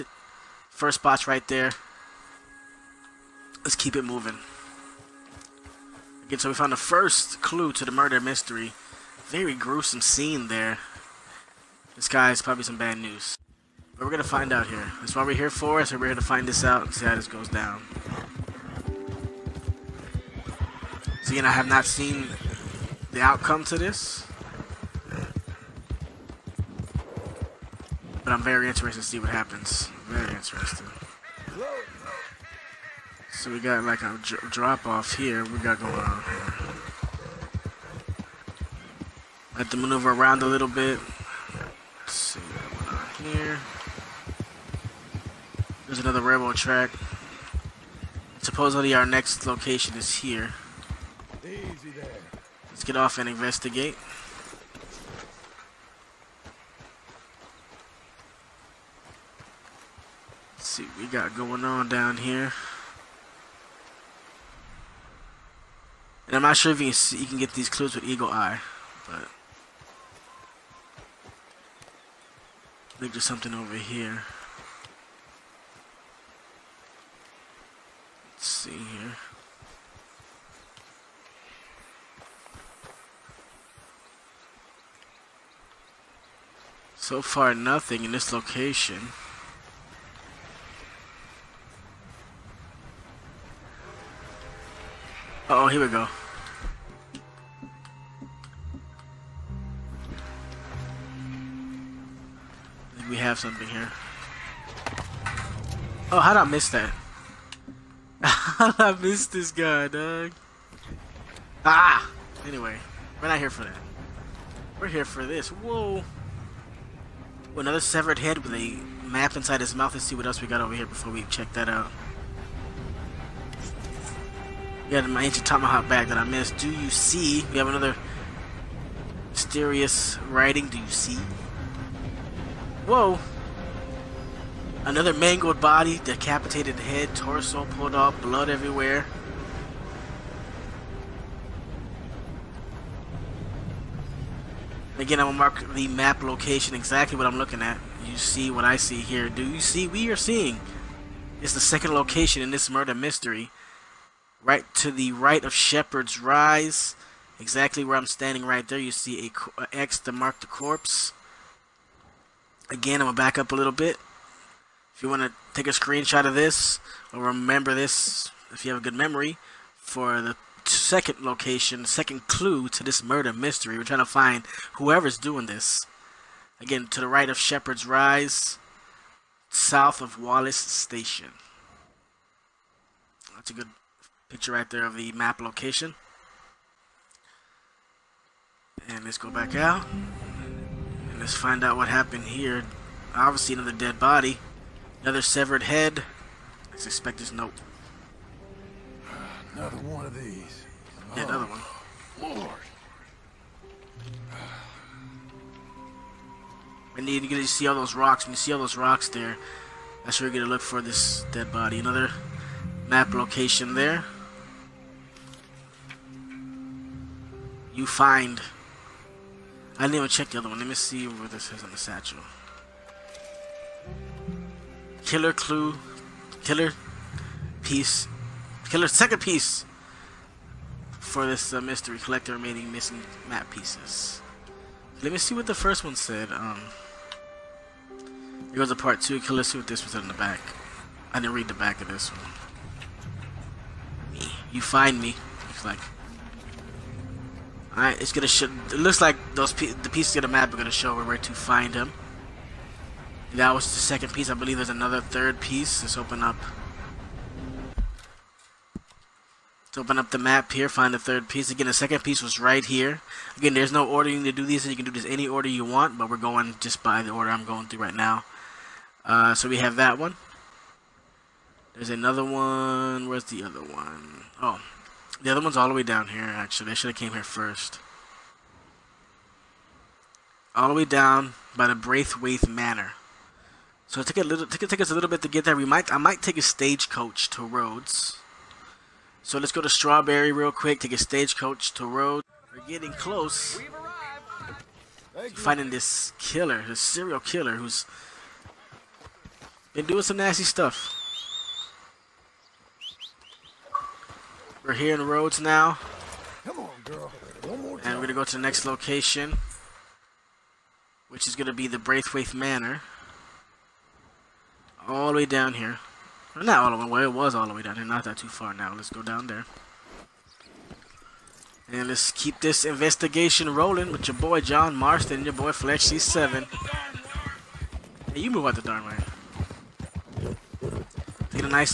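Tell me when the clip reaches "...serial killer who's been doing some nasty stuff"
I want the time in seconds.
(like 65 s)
296 s.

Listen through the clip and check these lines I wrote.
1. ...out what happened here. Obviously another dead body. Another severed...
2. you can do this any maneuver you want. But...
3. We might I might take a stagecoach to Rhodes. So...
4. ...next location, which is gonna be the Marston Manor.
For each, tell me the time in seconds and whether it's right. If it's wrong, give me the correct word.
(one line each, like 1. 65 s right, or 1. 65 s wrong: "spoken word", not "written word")
1. 191 s right
2. 264 s wrong: "order", not "maneuver"
3. 285 s right
4. 308 s wrong: "Braithwaite", not "Marston".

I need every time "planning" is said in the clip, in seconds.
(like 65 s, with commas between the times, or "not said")
not said.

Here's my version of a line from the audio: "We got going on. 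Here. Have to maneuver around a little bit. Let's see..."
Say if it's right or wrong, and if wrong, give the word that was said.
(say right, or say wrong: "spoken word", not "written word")
right.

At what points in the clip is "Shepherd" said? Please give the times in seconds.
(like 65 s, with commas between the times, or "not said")
155 s, 177 s.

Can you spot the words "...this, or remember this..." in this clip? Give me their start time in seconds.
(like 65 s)
166 s.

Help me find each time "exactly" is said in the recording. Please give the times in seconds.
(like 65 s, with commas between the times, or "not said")
146 s, 157 s.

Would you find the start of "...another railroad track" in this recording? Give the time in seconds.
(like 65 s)
45 s.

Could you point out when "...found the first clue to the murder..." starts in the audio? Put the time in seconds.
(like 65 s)
6 s.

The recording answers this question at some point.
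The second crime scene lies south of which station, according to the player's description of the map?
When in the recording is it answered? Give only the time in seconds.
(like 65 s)
180 s.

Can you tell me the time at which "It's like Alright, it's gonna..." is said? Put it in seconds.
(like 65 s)
245 s.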